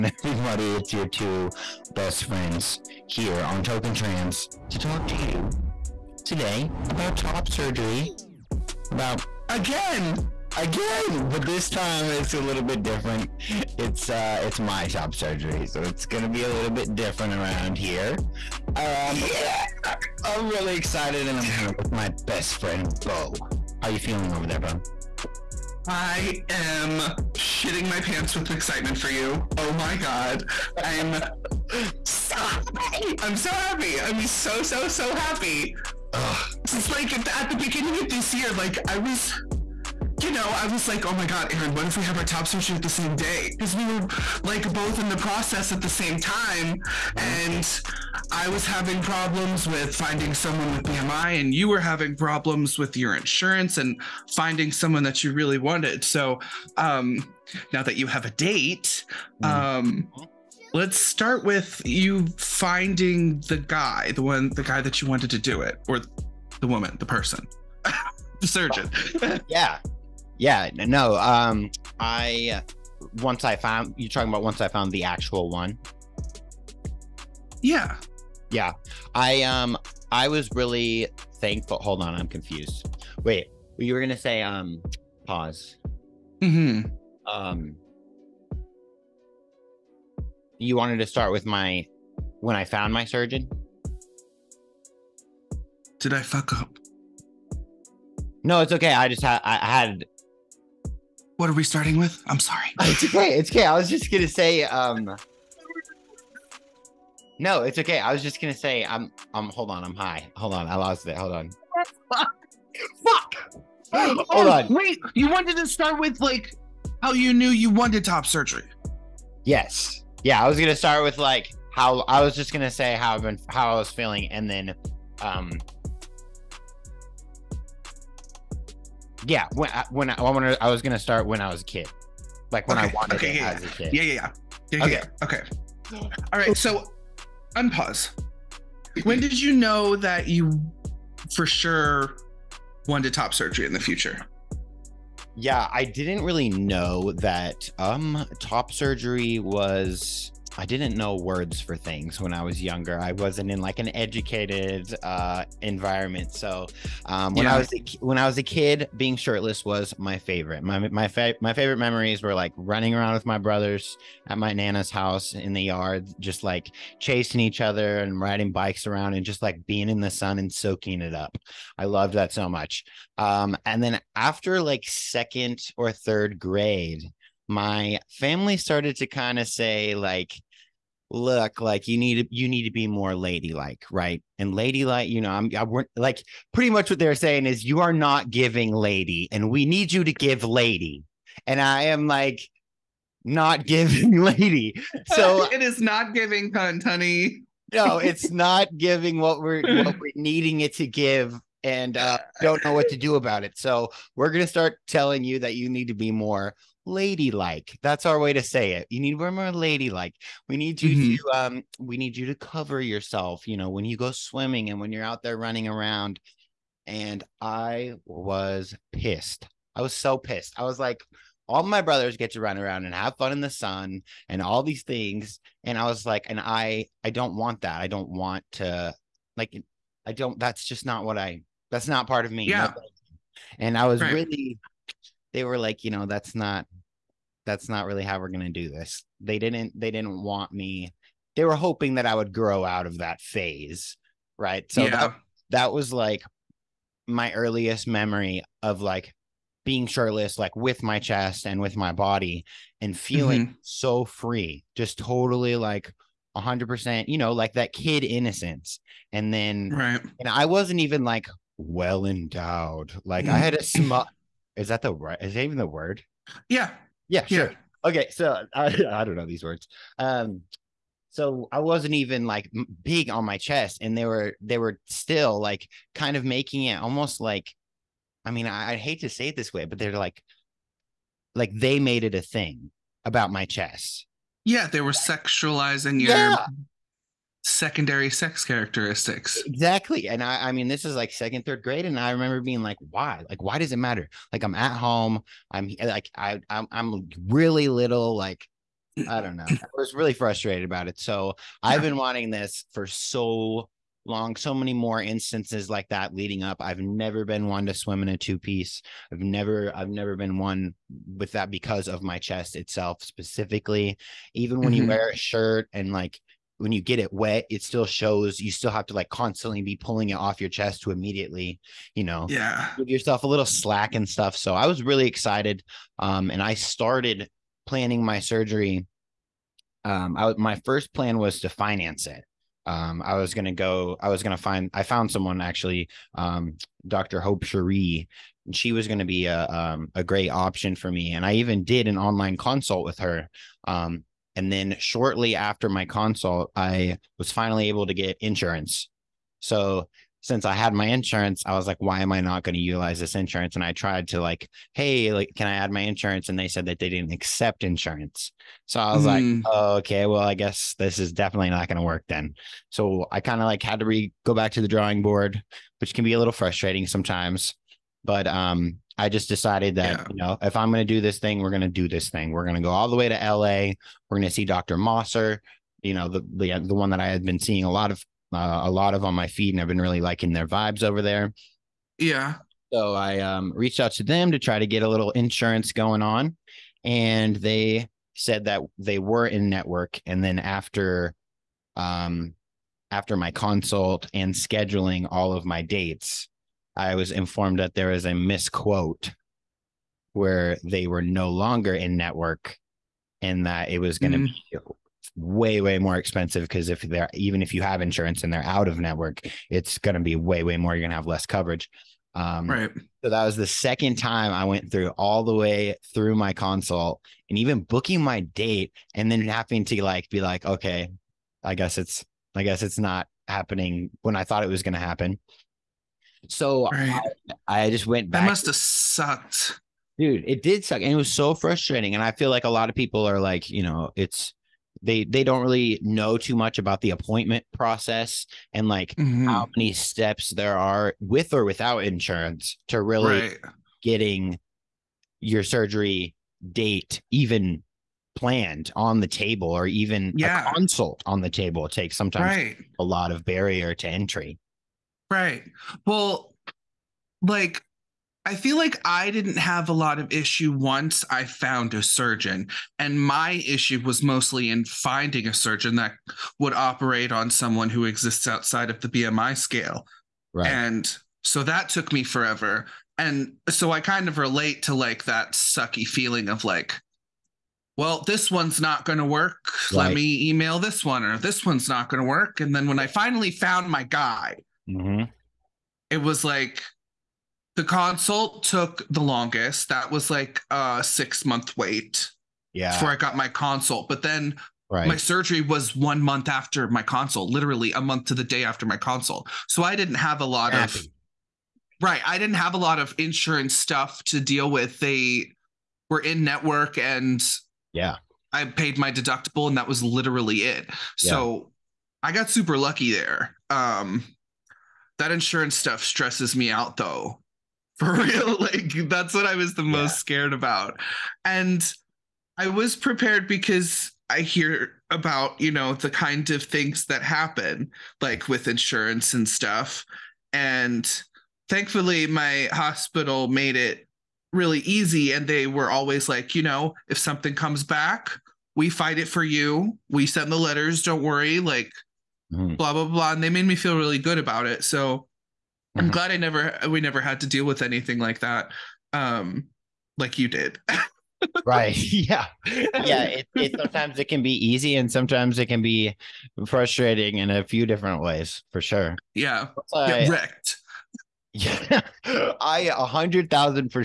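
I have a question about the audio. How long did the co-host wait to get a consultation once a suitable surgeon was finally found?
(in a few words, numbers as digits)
6 months.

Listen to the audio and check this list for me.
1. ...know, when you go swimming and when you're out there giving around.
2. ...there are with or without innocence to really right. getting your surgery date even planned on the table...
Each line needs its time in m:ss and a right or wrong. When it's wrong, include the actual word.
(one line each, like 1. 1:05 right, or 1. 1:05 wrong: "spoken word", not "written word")
1. 3:33 wrong: "running", not "giving"
2. 7:20 wrong: "insurance", not "innocence".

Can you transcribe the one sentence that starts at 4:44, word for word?
Yeah, they were sexualizing your yeah secondary sex characteristics.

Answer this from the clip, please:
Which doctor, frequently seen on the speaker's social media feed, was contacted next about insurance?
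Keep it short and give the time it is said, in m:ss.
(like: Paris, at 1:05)
Dr. Mosser, at 6:14.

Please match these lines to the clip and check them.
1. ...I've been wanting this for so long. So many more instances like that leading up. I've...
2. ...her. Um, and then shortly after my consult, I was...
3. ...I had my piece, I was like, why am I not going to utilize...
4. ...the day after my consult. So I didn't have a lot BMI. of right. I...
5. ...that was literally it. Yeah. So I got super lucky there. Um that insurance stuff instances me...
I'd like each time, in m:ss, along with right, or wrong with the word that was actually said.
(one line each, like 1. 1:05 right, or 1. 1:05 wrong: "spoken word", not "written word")
1. 5:01 right
2. 5:42 right
3. 5:50 wrong: "insurance", not "piece"
4. 8:18 wrong: "Happy", not "BMI"
5. 8:29 wrong: "stresses", not "instances".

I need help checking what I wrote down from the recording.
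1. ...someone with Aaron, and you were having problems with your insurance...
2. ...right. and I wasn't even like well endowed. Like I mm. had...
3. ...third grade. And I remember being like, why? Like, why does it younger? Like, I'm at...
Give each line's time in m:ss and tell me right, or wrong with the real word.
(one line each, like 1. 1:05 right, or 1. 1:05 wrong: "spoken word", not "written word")
1. 0:50 wrong: "BMI", not "Aaron"
2. 4:19 right
3. 4:51 wrong: "matter", not "younger".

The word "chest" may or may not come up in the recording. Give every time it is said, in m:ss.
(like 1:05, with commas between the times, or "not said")
4:10, 4:33, 4:43, 5:12, 5:20.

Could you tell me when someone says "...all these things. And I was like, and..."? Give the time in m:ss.
3:44.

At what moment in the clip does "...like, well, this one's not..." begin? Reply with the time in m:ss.
7:56.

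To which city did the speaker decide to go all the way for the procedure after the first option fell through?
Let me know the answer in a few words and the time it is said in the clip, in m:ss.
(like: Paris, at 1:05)
LA, at 6:13.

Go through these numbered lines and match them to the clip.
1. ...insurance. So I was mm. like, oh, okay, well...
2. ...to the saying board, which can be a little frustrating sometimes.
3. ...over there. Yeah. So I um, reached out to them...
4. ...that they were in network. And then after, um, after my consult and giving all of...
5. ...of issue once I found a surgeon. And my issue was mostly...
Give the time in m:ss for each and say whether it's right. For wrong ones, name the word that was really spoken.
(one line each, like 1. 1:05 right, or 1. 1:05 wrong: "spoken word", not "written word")
1. 5:57 right
2. 6:04 wrong: "drawing", not "saying"
3. 6:20 right
4. 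6:28 wrong: "scheduling", not "giving"
5. 7:39 right.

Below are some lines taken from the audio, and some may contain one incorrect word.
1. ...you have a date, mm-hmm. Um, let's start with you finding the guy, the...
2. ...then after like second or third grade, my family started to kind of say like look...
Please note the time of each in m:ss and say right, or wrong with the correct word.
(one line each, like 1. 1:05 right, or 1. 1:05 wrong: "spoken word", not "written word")
1. 0:57 right
2. 2:53 right.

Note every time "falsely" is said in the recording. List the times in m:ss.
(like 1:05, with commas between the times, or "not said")
not said.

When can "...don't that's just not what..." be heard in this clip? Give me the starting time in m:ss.
3:50.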